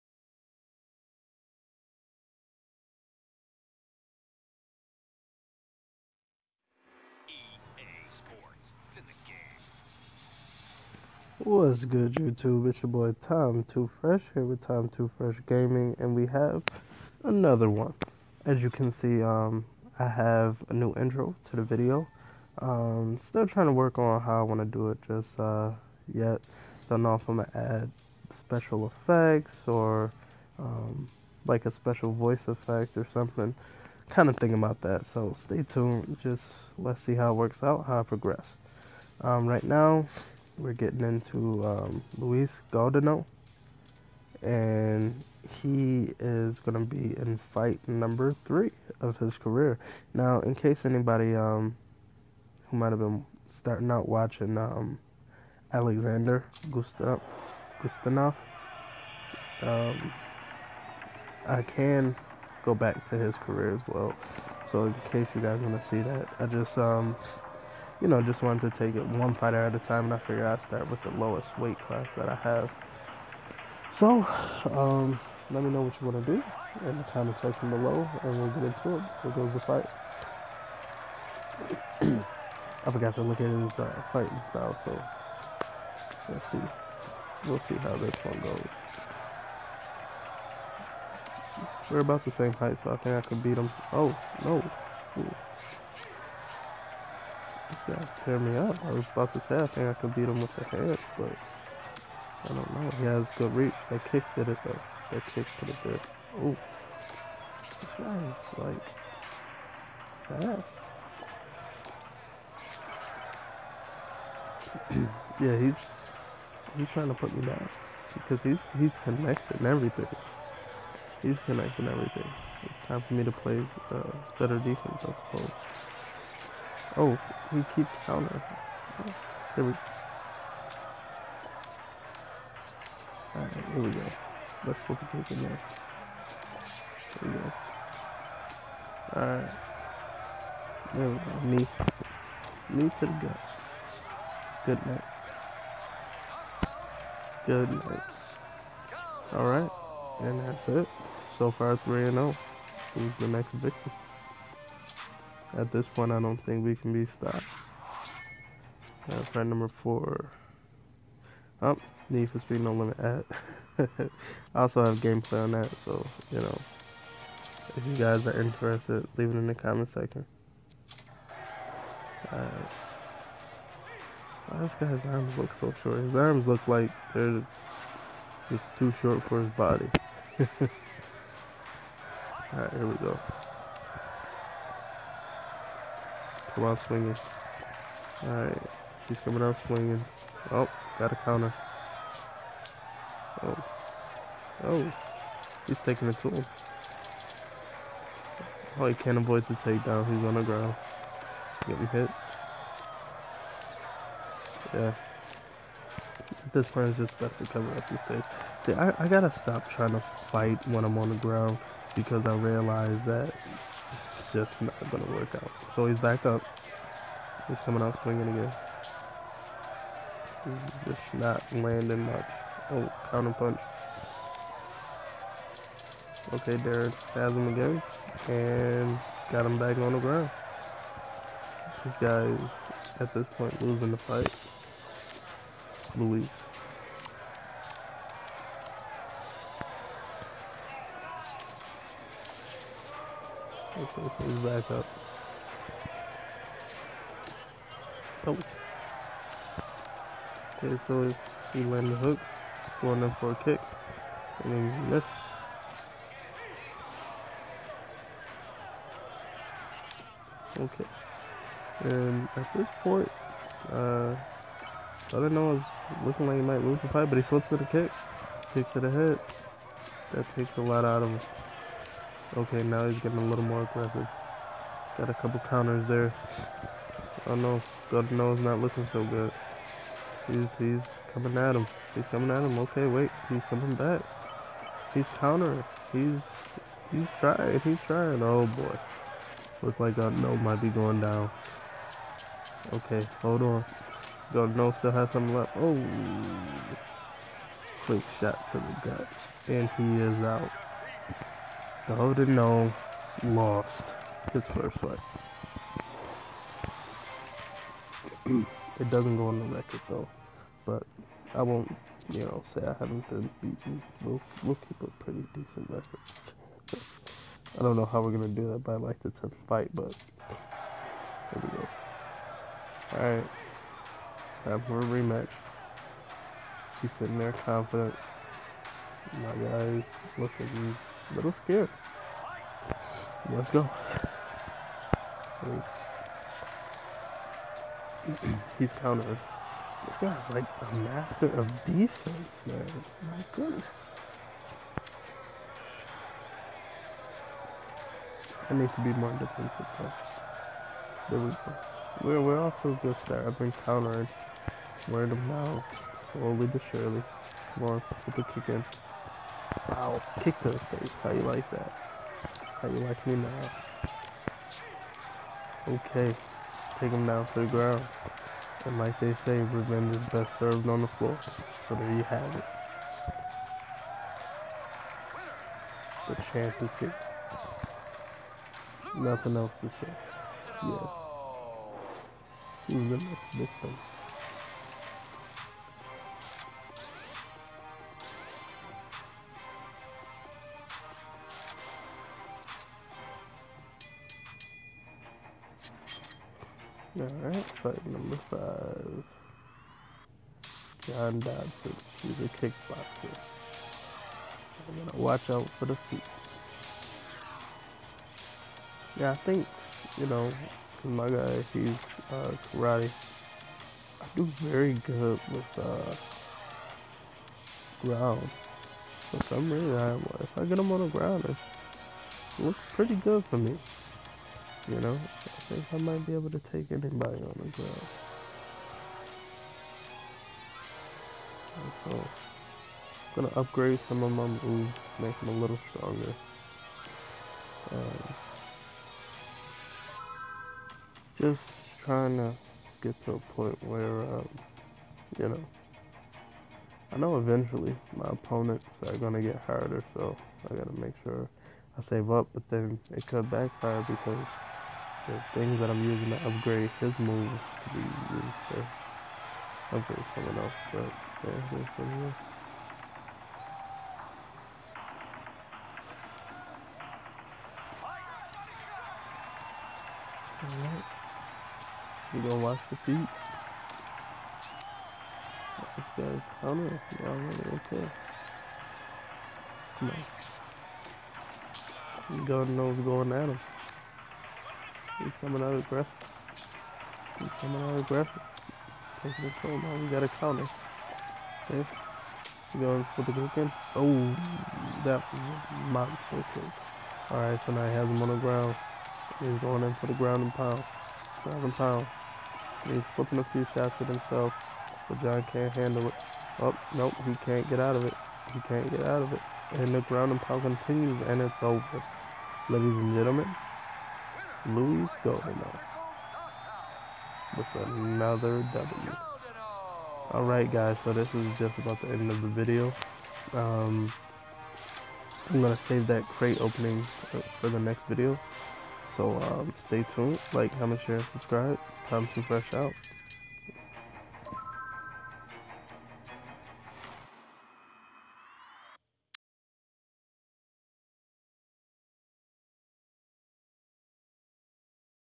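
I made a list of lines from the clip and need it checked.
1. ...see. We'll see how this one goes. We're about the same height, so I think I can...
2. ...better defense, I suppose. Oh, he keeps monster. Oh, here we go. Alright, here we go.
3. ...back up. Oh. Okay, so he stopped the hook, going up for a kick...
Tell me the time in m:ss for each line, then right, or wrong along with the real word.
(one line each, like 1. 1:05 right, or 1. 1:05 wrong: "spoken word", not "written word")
1. 1:26 right
2. 2:04 wrong: "counter", not "monster"
3. 4:04 wrong: "landed", not "stopped".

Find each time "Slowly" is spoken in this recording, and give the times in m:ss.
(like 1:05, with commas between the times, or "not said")
5:56.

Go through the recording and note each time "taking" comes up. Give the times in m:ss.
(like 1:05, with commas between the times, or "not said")
3:15, 8:09.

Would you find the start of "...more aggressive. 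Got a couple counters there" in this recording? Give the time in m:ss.
4:33.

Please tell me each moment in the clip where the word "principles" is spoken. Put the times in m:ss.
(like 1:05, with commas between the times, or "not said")
not said.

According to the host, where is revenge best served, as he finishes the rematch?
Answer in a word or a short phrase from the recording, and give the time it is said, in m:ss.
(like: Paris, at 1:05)
on the floor, at 6:10.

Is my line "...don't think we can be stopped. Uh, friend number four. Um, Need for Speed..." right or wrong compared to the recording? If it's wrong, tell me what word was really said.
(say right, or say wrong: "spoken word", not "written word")
right.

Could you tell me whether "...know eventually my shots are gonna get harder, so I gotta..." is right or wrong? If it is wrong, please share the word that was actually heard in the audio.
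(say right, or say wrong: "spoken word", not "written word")
wrong: "opponents", not "shots".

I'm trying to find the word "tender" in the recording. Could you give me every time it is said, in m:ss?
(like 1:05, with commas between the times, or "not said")
not said.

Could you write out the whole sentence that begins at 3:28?
See, I, I gotta stop trying to fight when I'm on the ground because I realize that just not gonna work out.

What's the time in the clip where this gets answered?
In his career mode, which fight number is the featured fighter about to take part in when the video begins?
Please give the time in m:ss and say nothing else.
0:47.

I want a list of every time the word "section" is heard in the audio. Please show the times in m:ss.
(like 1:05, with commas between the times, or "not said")
1:17, 2:49.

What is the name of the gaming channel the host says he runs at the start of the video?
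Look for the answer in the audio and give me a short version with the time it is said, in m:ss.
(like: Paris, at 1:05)
Tom2Fresh Gaming, at 0:14.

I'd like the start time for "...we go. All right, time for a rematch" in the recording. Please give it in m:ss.
5:21.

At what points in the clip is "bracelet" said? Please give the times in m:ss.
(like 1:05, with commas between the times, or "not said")
not said.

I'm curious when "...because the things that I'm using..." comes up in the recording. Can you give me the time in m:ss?
7:33.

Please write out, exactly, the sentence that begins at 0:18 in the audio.
As you can see, um, I have a new intro to the video.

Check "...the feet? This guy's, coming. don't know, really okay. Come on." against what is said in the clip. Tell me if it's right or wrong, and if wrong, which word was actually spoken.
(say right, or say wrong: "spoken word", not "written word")
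right.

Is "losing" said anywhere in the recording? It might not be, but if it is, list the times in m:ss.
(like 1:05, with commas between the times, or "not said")
3:53.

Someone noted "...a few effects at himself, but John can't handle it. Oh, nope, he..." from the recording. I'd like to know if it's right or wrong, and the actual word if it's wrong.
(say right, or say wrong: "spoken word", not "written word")
wrong: "shots", not "effects".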